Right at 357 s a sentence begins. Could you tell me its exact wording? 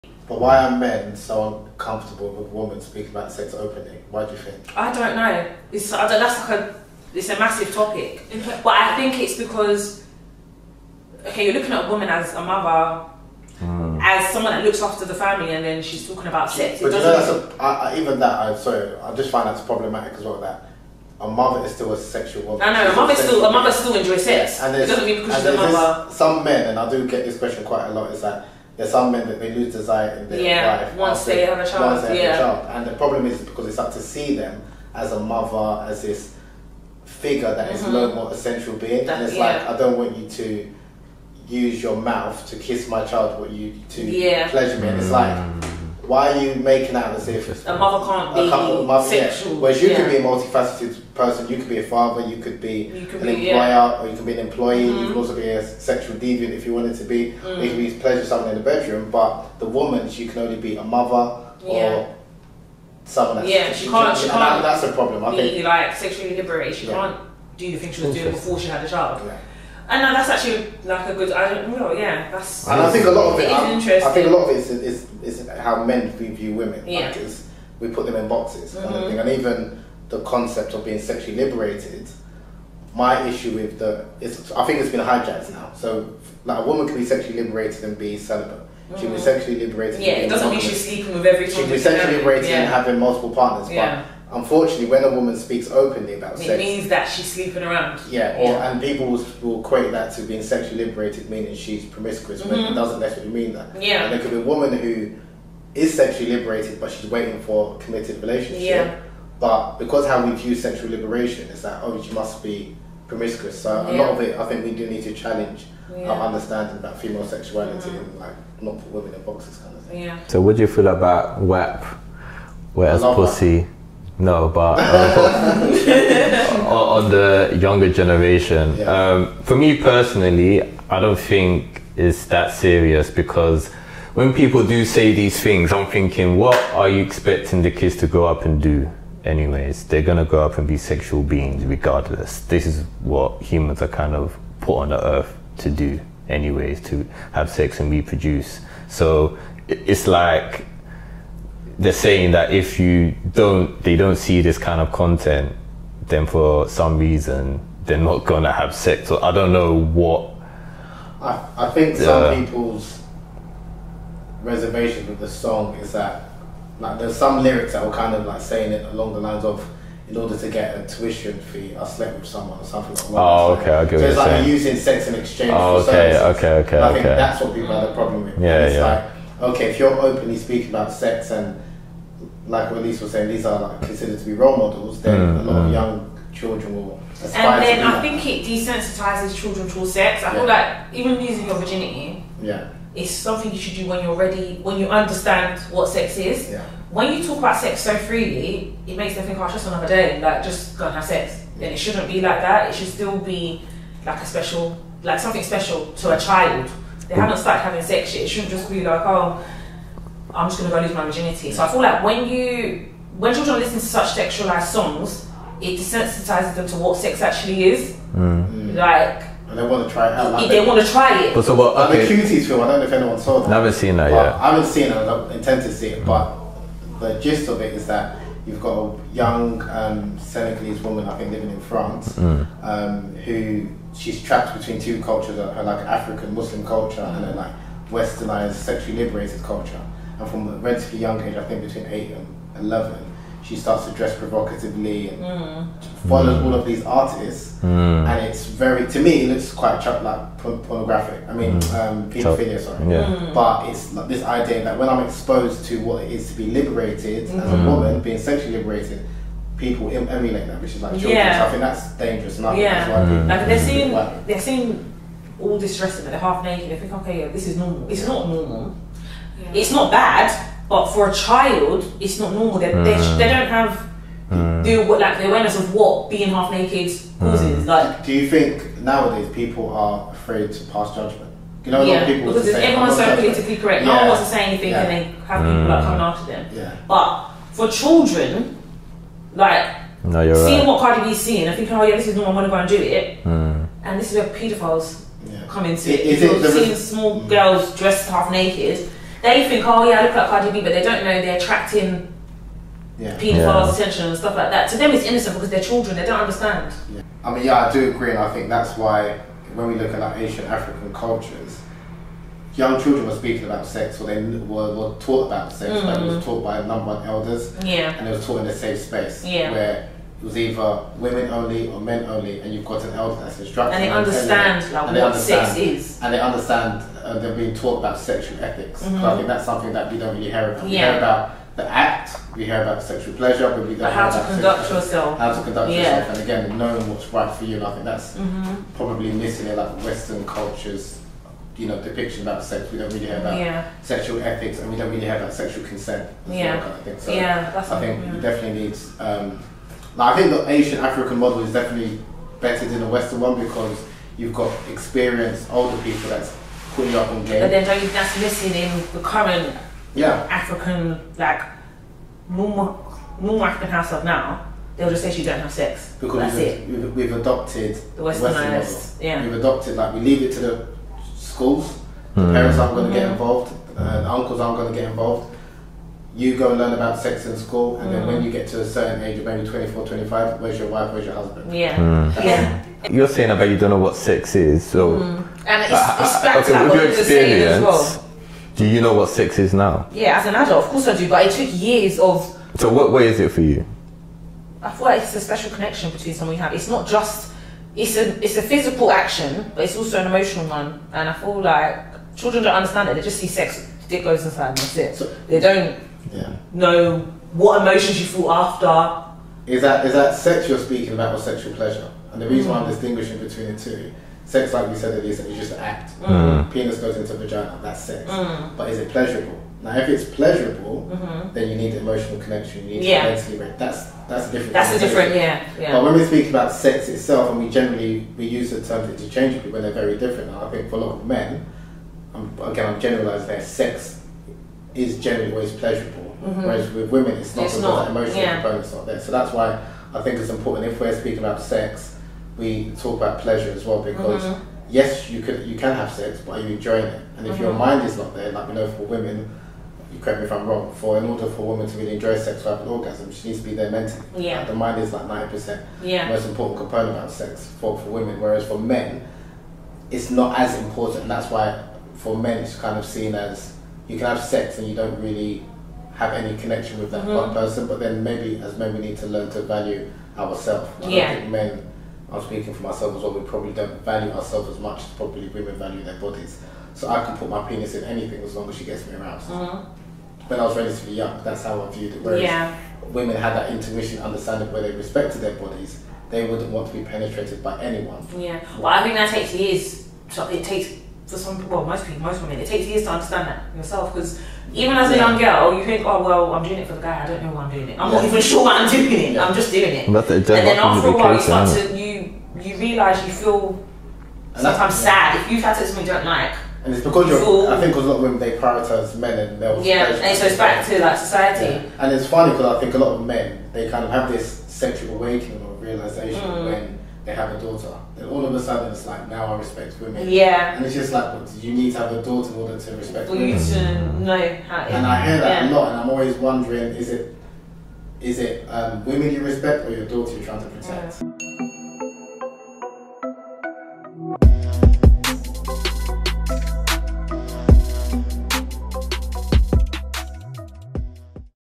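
But then don't you, that's missing in the current yeah African like normal normal African of now.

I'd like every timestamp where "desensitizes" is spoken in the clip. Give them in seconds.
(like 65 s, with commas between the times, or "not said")
188 s, 215 s.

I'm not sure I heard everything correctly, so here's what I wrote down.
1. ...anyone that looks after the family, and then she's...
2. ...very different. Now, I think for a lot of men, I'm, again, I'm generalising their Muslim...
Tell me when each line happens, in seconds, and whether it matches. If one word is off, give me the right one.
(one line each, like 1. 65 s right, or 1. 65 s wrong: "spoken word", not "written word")
1. 14 s wrong: "someone", not "anyone"
2. 429 s wrong: "Sex", not "Muslim".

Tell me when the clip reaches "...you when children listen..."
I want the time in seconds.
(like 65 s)
212 s.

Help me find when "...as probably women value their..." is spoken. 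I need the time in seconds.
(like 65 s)
474 s.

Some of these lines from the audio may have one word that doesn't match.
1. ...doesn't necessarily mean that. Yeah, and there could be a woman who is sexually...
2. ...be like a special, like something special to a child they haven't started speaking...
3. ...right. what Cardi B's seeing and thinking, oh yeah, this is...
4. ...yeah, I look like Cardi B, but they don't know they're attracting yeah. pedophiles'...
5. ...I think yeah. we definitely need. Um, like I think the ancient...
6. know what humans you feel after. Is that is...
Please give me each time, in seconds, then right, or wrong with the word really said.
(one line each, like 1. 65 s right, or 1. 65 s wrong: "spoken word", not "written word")
1. 102 s right
2. 203 s wrong: "having", not "speaking"
3. 290 s right
4. 299 s right
5. 347 s right
6. 406 s wrong: "emotions", not "humans".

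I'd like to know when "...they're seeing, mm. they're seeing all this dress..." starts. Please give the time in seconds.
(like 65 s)
263 s.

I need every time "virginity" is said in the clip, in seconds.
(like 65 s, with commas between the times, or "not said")
191 s, 211 s.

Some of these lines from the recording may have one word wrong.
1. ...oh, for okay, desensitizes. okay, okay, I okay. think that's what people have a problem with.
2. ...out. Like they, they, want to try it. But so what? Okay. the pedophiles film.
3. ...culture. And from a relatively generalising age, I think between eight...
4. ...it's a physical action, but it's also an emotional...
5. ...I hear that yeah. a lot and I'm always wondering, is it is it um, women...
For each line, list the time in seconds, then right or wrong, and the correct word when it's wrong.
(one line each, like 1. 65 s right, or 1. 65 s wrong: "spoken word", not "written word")
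1. 175 s wrong: "services", not "desensitizes"
2. 220 s wrong: "cuties", not "pedophiles"
3. 239 s wrong: "young", not "generalising"
4. 398 s right
5. 524 s right.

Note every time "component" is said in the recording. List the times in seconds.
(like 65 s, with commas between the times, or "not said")
438 s, 456 s.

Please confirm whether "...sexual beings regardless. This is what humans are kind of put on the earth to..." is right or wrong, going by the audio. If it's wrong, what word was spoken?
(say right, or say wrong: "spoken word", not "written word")
right.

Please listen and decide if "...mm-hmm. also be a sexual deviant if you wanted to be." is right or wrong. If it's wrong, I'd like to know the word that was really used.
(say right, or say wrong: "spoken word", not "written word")
right.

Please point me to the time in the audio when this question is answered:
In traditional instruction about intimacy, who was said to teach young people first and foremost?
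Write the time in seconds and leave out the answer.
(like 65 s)
317 s.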